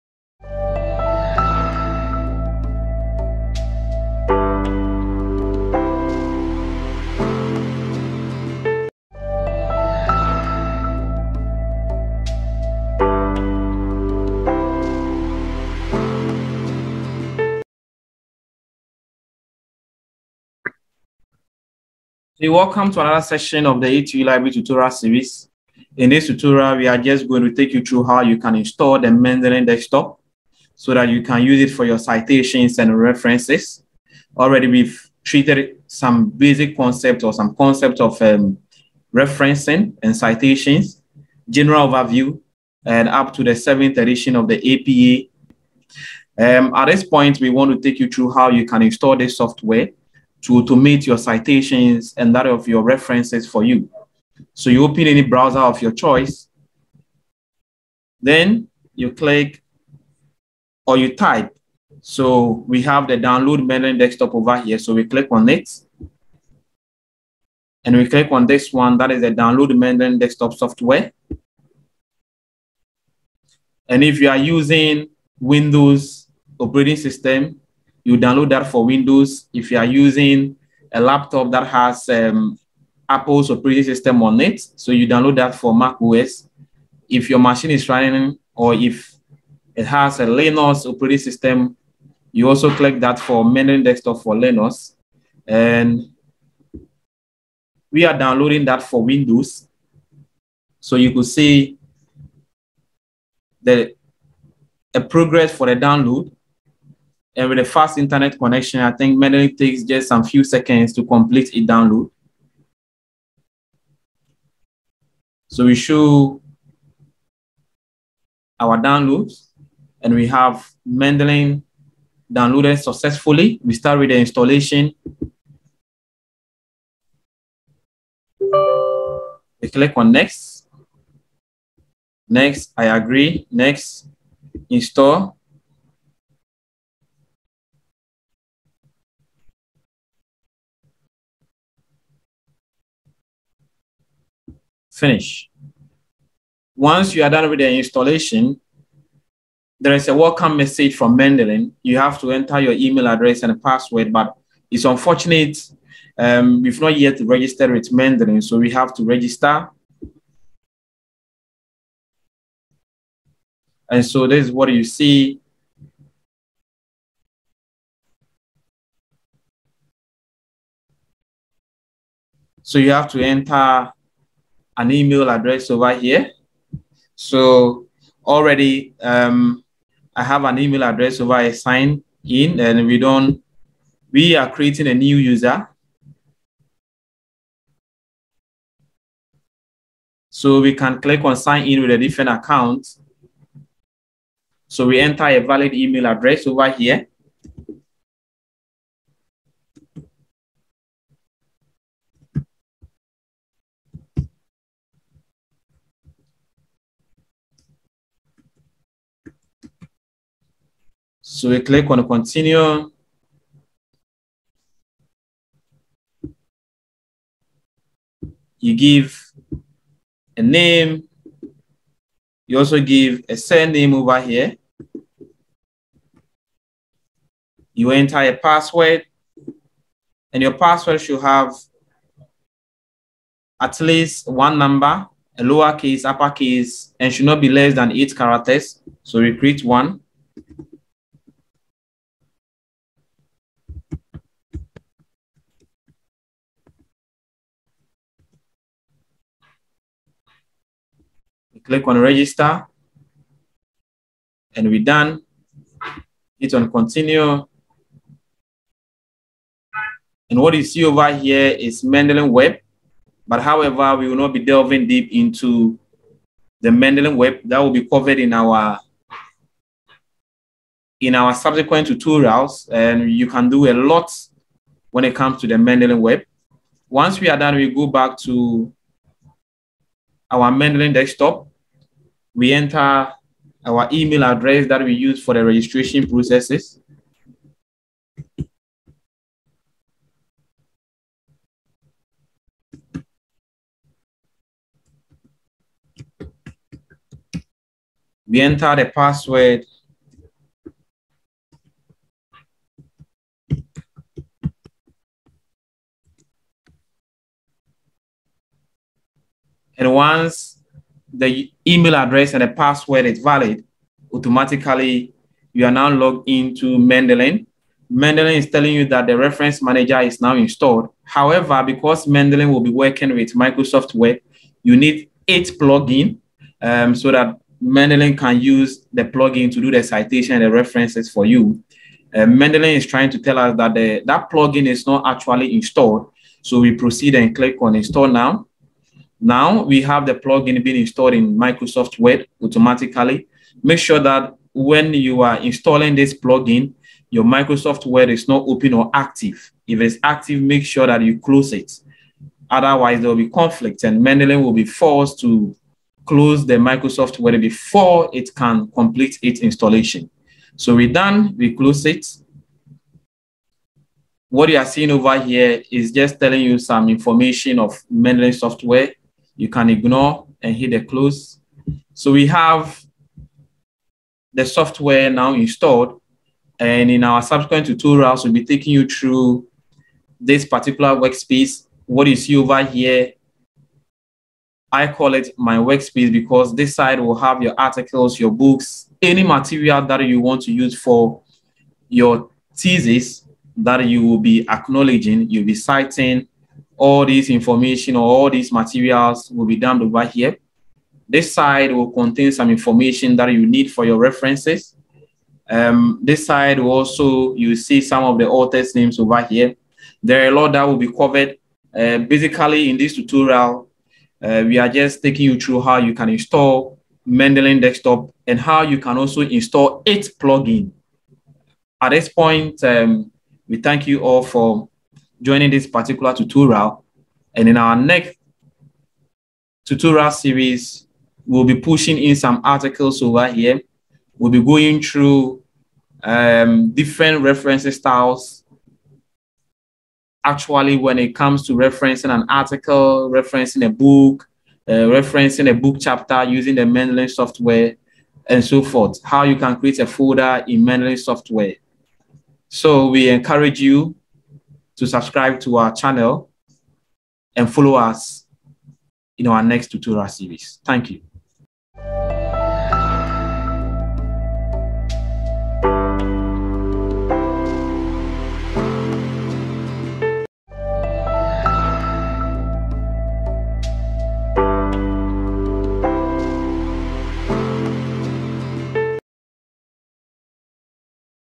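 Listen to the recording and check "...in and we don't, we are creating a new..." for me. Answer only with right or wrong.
right.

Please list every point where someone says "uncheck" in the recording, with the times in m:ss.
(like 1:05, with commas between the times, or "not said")
not said.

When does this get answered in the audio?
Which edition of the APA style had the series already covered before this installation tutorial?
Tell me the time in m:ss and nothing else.
0:43.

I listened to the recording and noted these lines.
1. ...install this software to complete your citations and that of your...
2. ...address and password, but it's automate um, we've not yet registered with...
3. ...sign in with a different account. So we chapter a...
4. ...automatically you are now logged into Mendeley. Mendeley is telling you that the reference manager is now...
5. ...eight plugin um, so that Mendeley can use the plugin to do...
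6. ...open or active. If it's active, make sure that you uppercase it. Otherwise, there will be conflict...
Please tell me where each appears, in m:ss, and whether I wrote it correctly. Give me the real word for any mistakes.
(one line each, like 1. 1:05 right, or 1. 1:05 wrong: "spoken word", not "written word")
1. 0:48 wrong: "automate", not "complete"
2. 2:33 wrong: "unfortunate", not "automate"
3. 3:11 wrong: "enter", not "chapter"
4. 5:14 right
5. 5:25 right
6. 5:48 wrong: "close", not "uppercase".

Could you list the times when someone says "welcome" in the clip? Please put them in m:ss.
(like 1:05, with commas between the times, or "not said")
0:22, 2:30.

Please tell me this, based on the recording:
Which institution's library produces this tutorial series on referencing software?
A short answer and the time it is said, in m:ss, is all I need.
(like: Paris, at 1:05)
ATU Library, at 0:23.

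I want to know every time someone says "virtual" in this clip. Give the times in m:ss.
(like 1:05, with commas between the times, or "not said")
not said.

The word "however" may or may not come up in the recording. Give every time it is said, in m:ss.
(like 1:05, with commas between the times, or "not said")
4:23, 5:21.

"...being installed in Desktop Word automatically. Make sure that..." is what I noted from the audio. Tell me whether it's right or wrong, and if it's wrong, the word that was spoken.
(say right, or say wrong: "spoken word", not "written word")
wrong: "Microsoft", not "Desktop".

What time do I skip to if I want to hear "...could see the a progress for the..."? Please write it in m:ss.
1:41.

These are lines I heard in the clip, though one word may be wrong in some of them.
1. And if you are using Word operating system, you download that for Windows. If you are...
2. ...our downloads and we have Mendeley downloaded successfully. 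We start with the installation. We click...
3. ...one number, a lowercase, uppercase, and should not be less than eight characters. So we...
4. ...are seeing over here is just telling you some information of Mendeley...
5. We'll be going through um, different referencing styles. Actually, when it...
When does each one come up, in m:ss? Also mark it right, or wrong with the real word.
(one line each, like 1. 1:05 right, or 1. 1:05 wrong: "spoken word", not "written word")
1. 1:13 wrong: "Windows", not "Word"
2. 1:58 right
3. 3:54 right
4. 6:04 right
5. 7:14 right.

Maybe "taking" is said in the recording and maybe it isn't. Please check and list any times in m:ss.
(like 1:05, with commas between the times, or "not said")
6:18, 6:55.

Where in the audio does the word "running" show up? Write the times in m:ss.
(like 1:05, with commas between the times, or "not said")
1:27.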